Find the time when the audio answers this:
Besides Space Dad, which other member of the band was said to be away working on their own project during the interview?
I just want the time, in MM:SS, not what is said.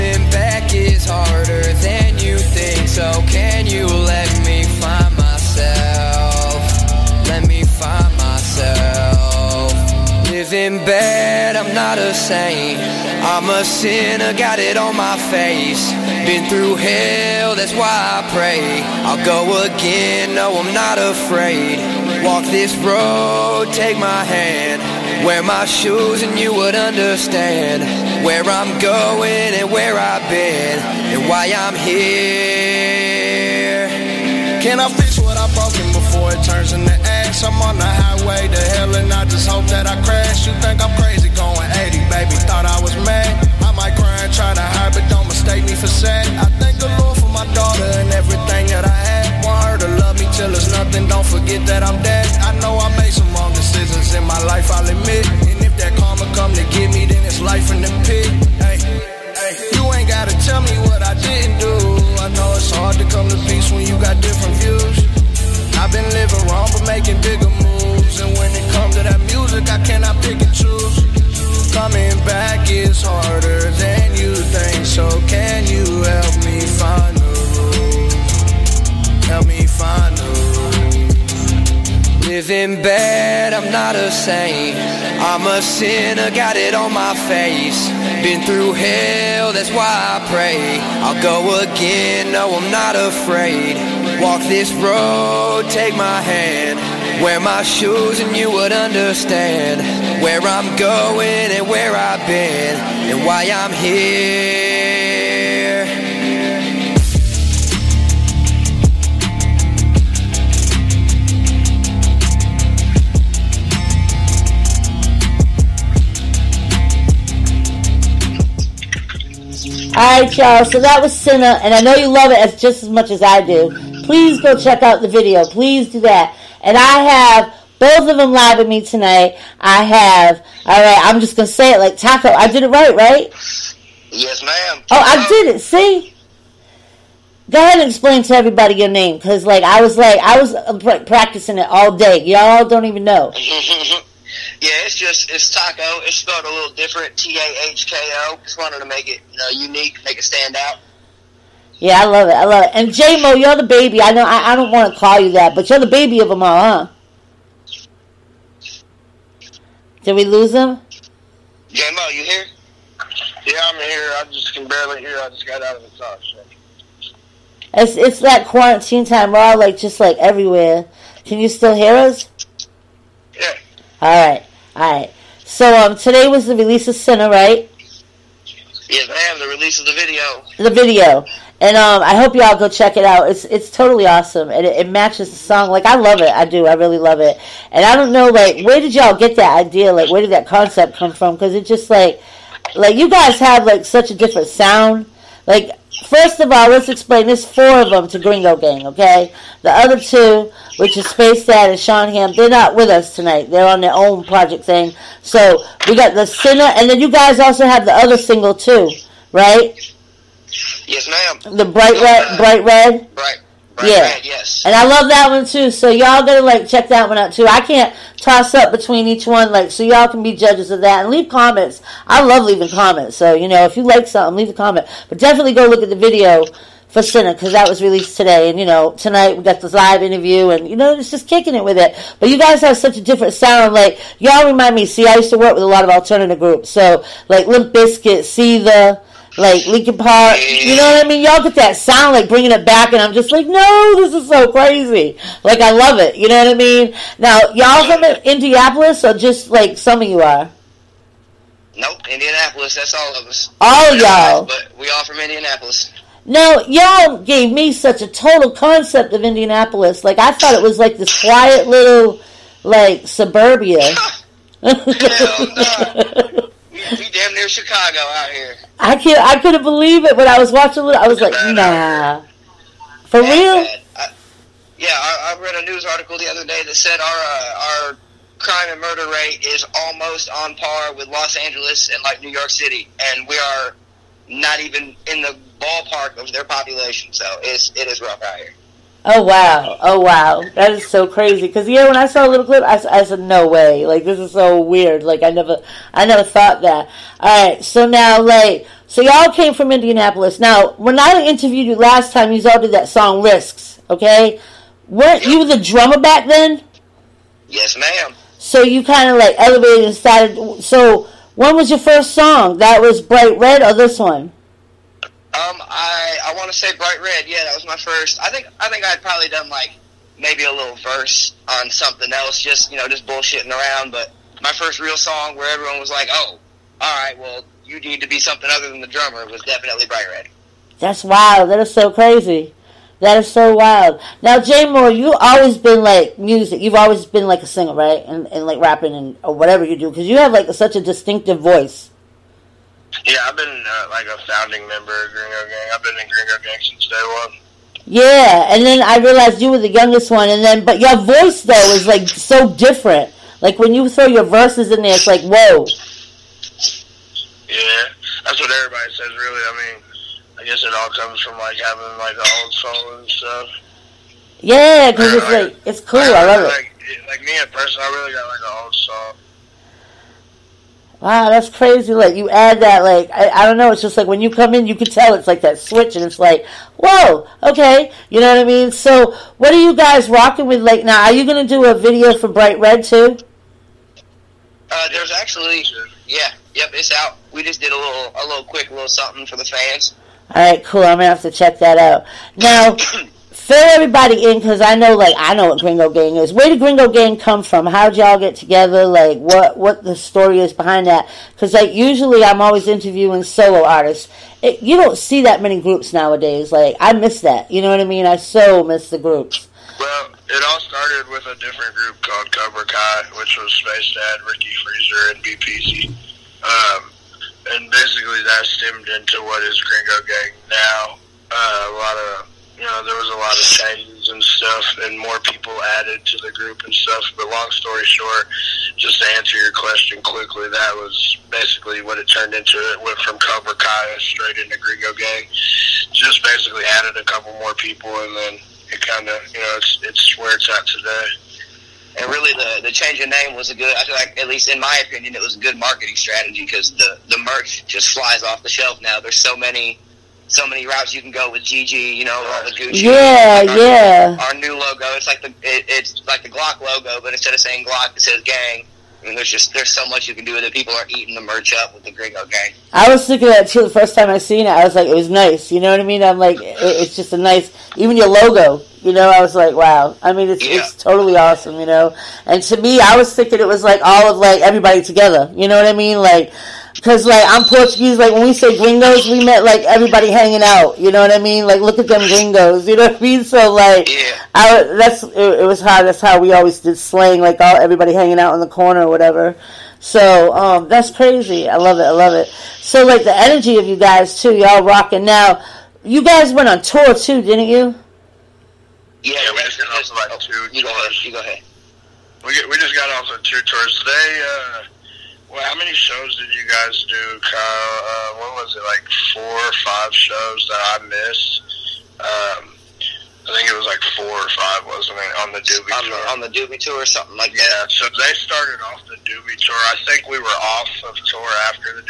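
03:21.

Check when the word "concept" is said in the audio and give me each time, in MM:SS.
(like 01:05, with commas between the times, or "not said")
03:10, 04:18.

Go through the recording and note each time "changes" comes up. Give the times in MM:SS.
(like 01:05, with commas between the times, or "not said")
07:03, 07:22.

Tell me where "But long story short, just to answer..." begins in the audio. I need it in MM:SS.
07:07.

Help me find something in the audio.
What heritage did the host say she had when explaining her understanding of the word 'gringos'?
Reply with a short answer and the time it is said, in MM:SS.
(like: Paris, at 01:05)
Portuguese, at 07:57.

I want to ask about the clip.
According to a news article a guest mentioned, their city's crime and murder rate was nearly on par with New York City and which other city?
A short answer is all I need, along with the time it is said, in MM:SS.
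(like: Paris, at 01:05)
Los Angeles, at 04:41.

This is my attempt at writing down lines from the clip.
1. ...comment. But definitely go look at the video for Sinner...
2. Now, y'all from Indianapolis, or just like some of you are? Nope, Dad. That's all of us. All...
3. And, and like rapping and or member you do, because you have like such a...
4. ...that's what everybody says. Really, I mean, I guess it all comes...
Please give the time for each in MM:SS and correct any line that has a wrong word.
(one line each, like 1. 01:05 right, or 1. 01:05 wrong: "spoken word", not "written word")
1. 03:44 right
2. 04:07 wrong: "Indianapolis", not "Dad"
3. 05:38 wrong: "whatever", not "member"
4. 05:58 right.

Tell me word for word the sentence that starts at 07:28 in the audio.
There's so many so many routes you can go with GG, you know, all the Gucci.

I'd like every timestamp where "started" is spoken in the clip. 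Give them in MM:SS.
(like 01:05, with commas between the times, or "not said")
05:09, 06:50, 08:38.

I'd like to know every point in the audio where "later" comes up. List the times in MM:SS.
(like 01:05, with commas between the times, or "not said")
not said.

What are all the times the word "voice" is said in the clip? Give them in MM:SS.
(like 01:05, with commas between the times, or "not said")
05:41, 05:50.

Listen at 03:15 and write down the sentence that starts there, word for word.
Like First of all, let's explain.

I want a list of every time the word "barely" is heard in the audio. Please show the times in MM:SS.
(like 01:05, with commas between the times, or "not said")
02:44.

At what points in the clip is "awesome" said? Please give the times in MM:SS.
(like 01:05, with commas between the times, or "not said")
03:04, 07:51.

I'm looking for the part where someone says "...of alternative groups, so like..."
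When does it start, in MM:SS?
03:55.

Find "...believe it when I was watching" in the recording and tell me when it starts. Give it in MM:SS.
04:29.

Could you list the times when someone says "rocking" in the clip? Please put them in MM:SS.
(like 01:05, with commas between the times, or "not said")
06:20, 08:14.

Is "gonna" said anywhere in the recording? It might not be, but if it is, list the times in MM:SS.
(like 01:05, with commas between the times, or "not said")
02:11, 06:21, 06:30.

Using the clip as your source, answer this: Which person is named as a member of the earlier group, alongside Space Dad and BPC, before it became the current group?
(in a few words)
Ricky Freezer.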